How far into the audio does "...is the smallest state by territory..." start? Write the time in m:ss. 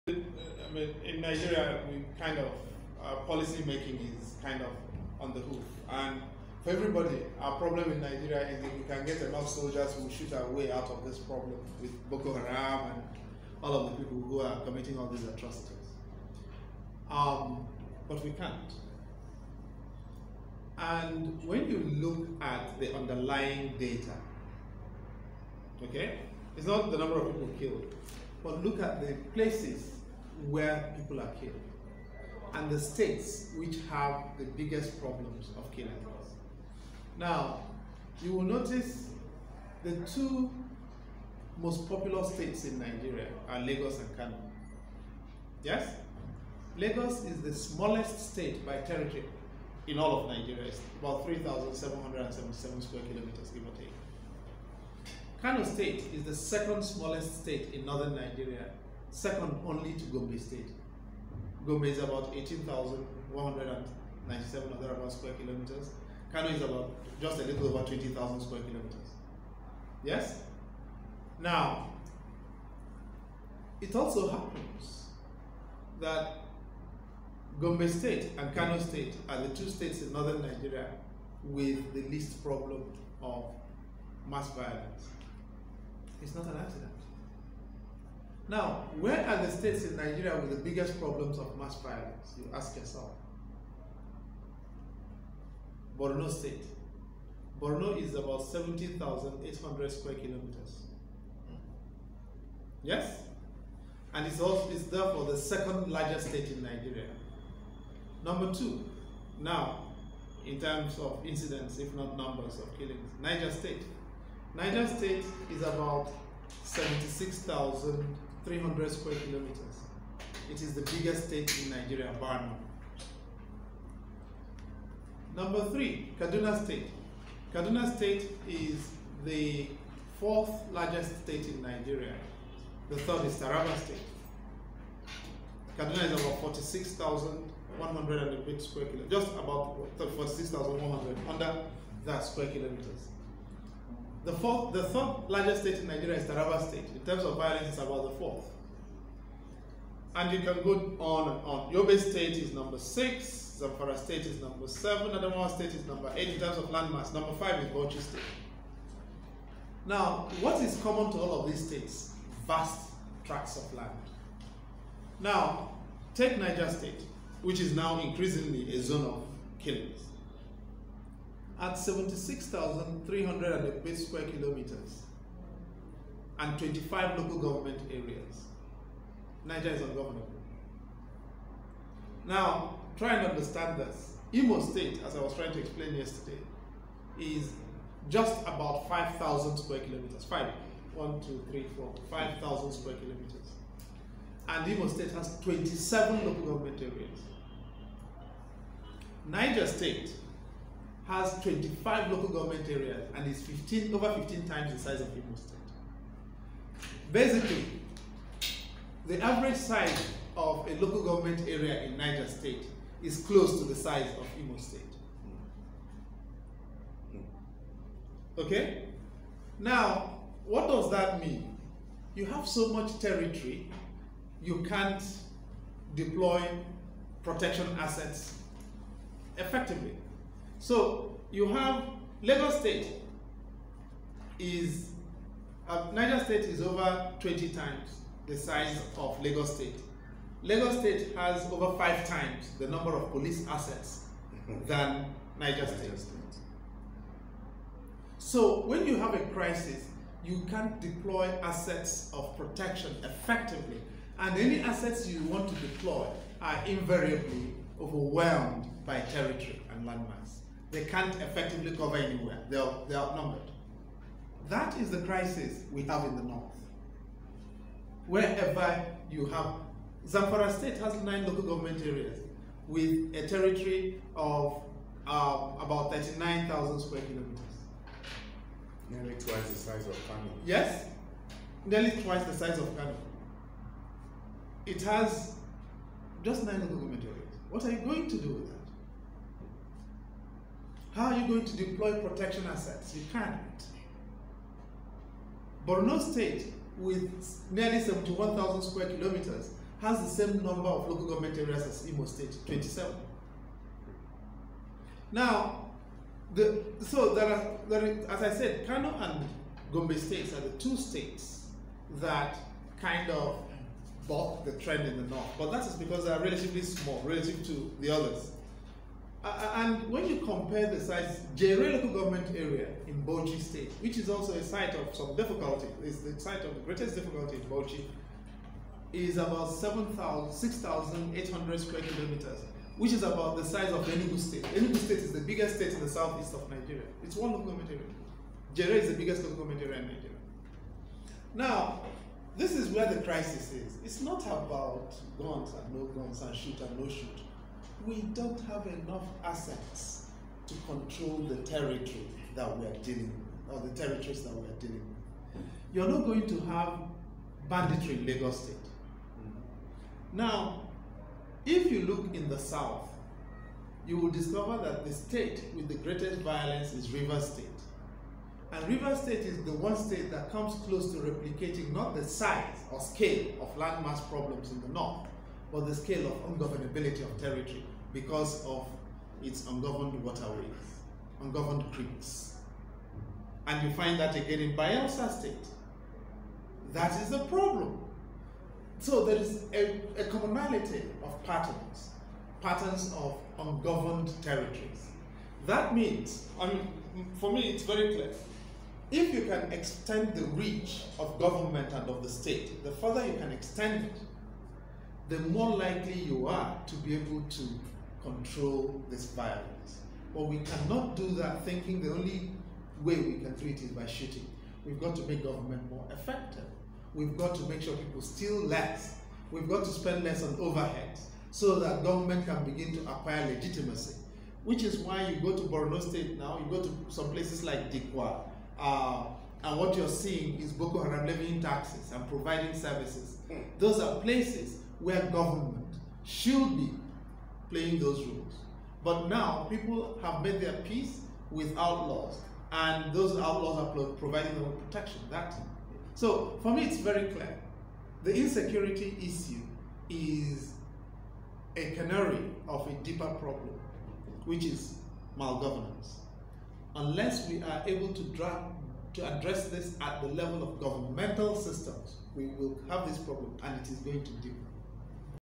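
0:47.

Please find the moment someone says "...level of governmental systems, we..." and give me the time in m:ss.
7:40.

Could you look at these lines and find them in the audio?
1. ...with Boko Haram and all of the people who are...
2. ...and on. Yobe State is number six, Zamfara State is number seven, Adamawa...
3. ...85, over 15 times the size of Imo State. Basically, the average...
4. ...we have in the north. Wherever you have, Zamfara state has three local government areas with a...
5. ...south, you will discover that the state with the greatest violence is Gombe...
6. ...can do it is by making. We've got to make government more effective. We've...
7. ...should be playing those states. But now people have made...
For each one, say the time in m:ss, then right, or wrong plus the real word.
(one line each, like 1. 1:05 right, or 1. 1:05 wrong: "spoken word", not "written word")
1. 0:11 right
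2. 2:31 right
3. 3:23 wrong: "15", not "85"
4. 4:25 wrong: "nine", not "three"
5. 6:02 wrong: "Rivers", not "Gombe"
6. 6:53 wrong: "shooting", not "making"
7. 7:16 wrong: "rules", not "states".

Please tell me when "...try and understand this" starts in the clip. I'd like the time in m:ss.
3:02.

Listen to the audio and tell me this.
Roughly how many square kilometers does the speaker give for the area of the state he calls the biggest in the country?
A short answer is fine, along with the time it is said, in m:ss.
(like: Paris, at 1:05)
76,308, at 2:51.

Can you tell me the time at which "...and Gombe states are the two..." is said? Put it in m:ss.
5:08.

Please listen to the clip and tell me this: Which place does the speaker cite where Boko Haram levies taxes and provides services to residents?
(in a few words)
Dikwa.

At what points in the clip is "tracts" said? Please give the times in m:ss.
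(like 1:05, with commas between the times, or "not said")
2:43.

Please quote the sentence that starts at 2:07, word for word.
Kaduna State is the fourth largest state in Nigeria.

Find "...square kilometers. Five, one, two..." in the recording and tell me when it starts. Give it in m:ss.
3:09.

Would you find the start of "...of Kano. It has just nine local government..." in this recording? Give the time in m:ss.
4:42.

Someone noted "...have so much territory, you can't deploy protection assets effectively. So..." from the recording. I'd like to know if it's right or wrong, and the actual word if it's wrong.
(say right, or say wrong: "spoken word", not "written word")
right.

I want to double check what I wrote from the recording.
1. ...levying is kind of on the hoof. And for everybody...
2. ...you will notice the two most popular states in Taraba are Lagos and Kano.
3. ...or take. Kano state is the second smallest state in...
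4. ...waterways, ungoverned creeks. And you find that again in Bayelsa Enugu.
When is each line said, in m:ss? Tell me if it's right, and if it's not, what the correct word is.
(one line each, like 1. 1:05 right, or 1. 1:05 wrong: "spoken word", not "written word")
1. 0:03 wrong: "making", not "levying"
2. 0:38 wrong: "Nigeria", not "Taraba"
3. 0:53 right
4. 6:20 wrong: "State", not "Enugu".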